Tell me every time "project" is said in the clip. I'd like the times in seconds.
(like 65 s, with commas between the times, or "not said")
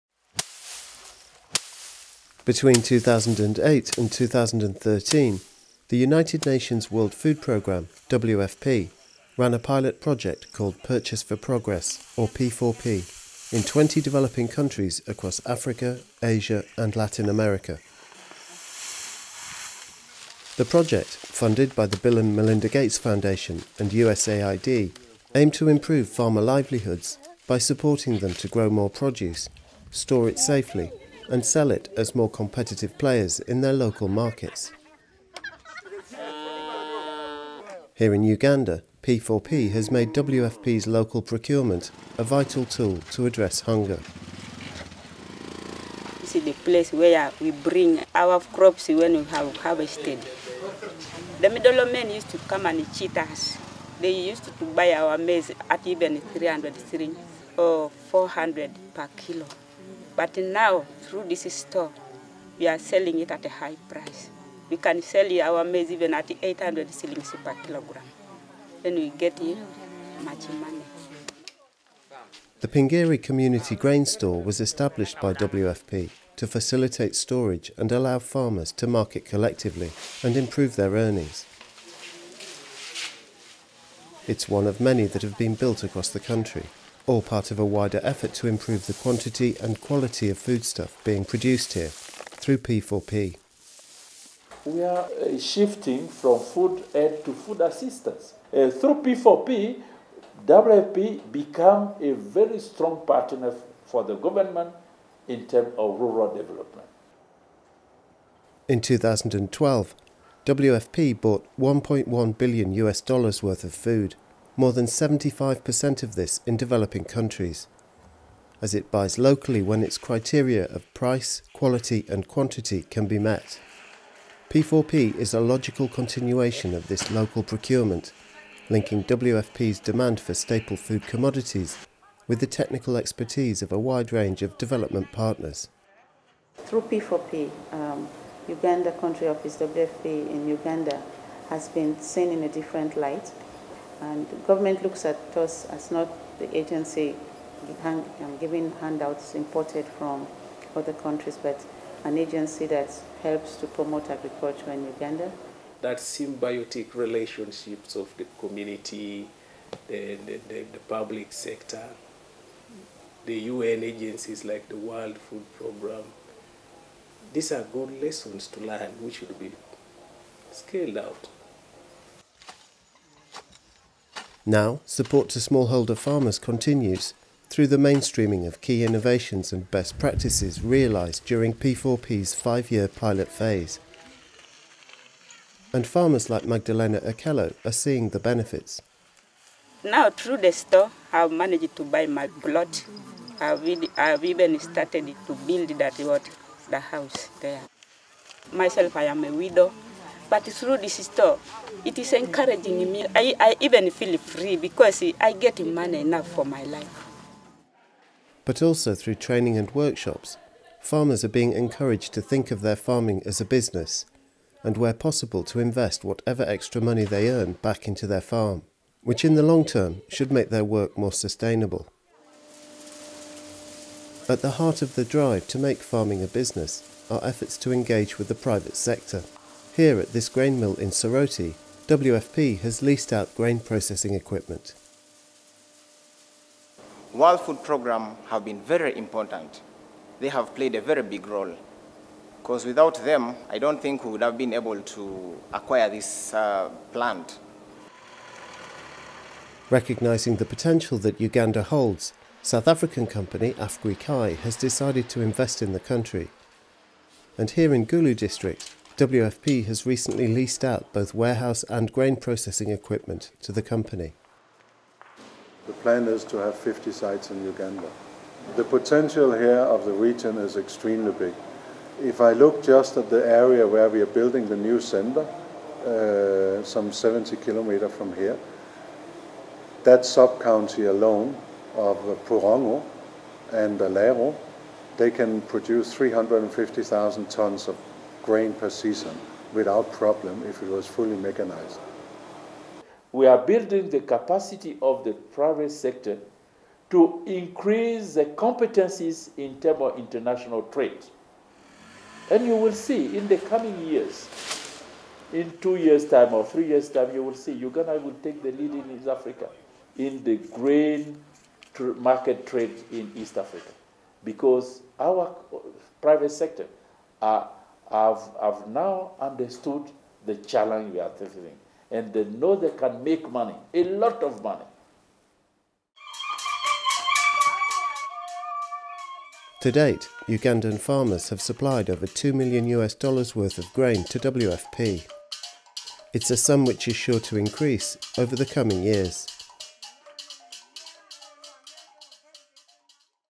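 10 s, 20 s.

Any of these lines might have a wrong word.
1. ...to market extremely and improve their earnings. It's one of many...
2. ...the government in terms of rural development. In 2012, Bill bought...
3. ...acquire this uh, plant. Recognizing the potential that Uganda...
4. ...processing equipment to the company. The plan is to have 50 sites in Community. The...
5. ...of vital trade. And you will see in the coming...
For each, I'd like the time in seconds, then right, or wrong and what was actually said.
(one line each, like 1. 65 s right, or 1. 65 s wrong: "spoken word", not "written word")
1. 78 s wrong: "collectively", not "extremely"
2. 104 s wrong: "WFP", not "Bill"
3. 245 s right
4. 262 s wrong: "Uganda", not "Community"
5. 299 s wrong: "international", not "vital".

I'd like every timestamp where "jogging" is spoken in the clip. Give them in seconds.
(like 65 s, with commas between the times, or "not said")
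not said.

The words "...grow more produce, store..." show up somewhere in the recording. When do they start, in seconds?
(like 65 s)
28 s.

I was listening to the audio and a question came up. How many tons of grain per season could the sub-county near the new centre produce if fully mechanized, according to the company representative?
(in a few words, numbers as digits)
350,000 tons.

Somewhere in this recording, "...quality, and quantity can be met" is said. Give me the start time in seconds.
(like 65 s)
121 s.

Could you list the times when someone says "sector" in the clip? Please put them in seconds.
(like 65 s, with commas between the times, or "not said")
161 s, 228 s, 295 s, 316 s.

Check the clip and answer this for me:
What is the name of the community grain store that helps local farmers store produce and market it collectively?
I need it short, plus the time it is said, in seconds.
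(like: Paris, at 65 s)
Pingiri, at 72 s.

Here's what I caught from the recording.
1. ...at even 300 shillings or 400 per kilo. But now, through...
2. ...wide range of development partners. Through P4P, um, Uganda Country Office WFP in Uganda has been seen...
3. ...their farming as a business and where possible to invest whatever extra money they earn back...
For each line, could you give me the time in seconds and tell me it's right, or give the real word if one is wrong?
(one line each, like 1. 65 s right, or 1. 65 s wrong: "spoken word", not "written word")
1. 55 s right
2. 133 s right
3. 212 s right.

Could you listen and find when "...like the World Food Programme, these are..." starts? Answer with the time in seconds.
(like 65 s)
164 s.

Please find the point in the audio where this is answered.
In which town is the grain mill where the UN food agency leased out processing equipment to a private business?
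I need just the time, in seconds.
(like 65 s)
230 s.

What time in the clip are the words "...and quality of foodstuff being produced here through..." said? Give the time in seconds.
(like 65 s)
89 s.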